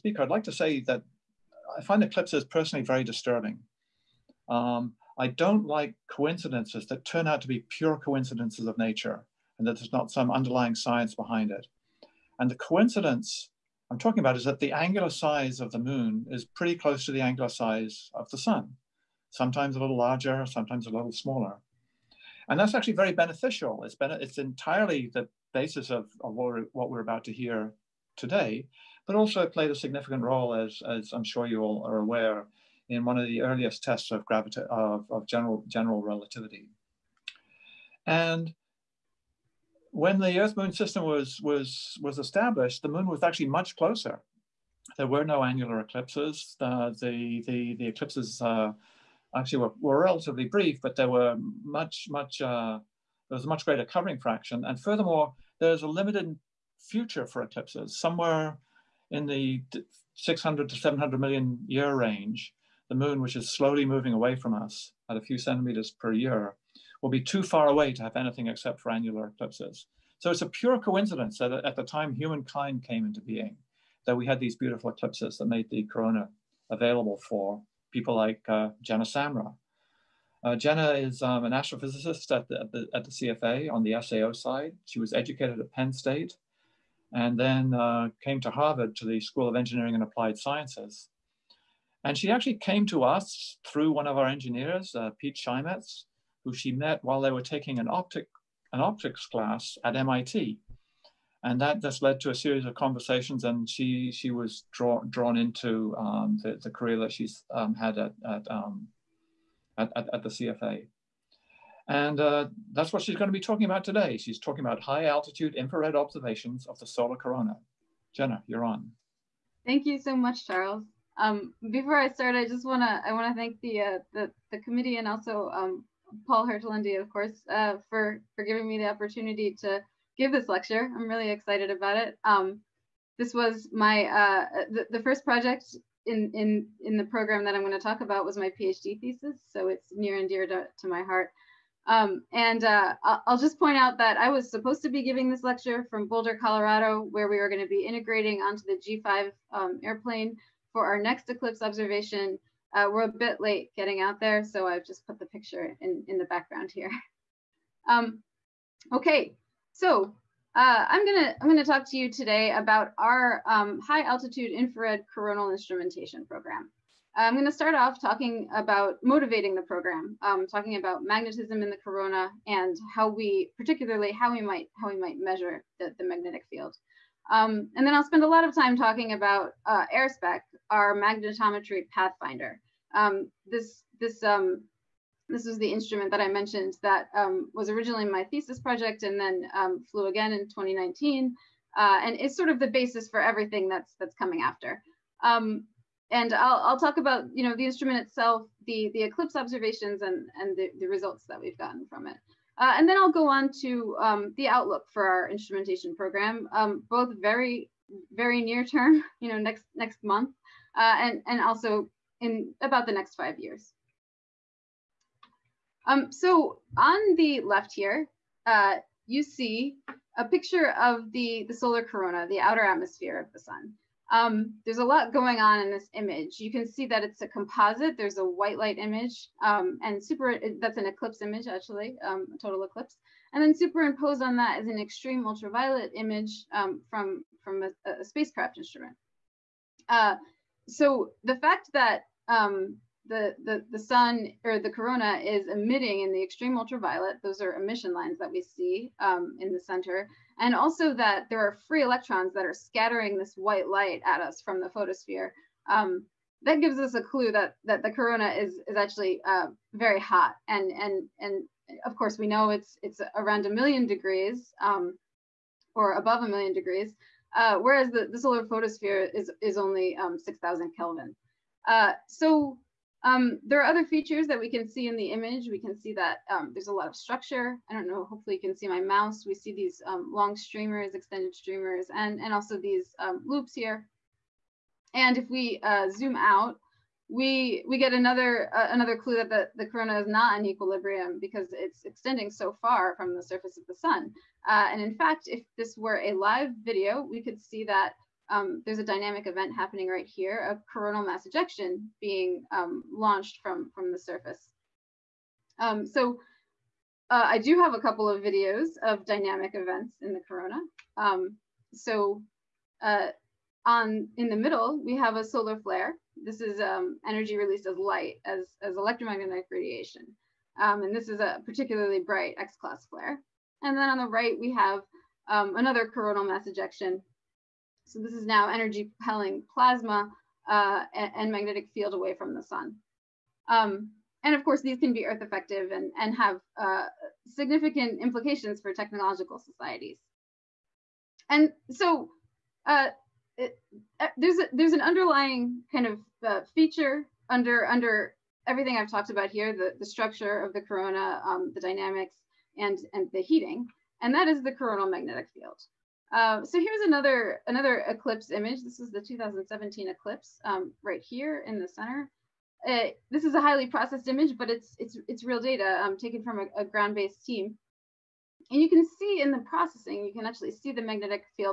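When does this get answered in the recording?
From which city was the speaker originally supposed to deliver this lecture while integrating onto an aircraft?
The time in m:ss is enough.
2:26.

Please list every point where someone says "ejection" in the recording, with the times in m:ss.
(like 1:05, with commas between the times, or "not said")
5:01, 5:26.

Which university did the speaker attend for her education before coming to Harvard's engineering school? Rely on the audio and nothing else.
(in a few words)
Penn State.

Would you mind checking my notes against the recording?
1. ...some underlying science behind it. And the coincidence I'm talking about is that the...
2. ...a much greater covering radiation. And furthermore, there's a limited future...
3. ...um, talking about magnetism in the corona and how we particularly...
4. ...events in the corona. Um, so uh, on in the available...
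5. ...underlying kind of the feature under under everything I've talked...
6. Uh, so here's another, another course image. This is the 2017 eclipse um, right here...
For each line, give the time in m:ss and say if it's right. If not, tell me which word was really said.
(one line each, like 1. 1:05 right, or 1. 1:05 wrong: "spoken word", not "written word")
1. 0:10 right
2. 0:53 wrong: "fraction", not "radiation"
3. 2:50 right
4. 5:09 wrong: "middle", not "available"
5. 5:44 right
6. 5:56 wrong: "eclipse", not "course".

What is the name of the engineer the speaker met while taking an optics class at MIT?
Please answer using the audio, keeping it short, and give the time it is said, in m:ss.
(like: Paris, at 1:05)
Pete Cheimets, at 1:35.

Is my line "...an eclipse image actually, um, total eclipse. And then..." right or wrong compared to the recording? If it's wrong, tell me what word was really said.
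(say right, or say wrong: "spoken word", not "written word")
right.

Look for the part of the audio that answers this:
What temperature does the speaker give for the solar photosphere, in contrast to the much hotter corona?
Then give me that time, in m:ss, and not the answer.
4:30.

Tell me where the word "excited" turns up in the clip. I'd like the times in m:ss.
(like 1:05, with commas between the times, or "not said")
2:11.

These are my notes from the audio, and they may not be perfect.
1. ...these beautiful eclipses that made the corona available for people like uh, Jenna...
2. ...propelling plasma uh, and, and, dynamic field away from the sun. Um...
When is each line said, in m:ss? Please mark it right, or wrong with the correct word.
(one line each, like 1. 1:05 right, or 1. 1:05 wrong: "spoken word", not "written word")
1. 1:14 right
2. 5:28 wrong: "magnetic", not "dynamic".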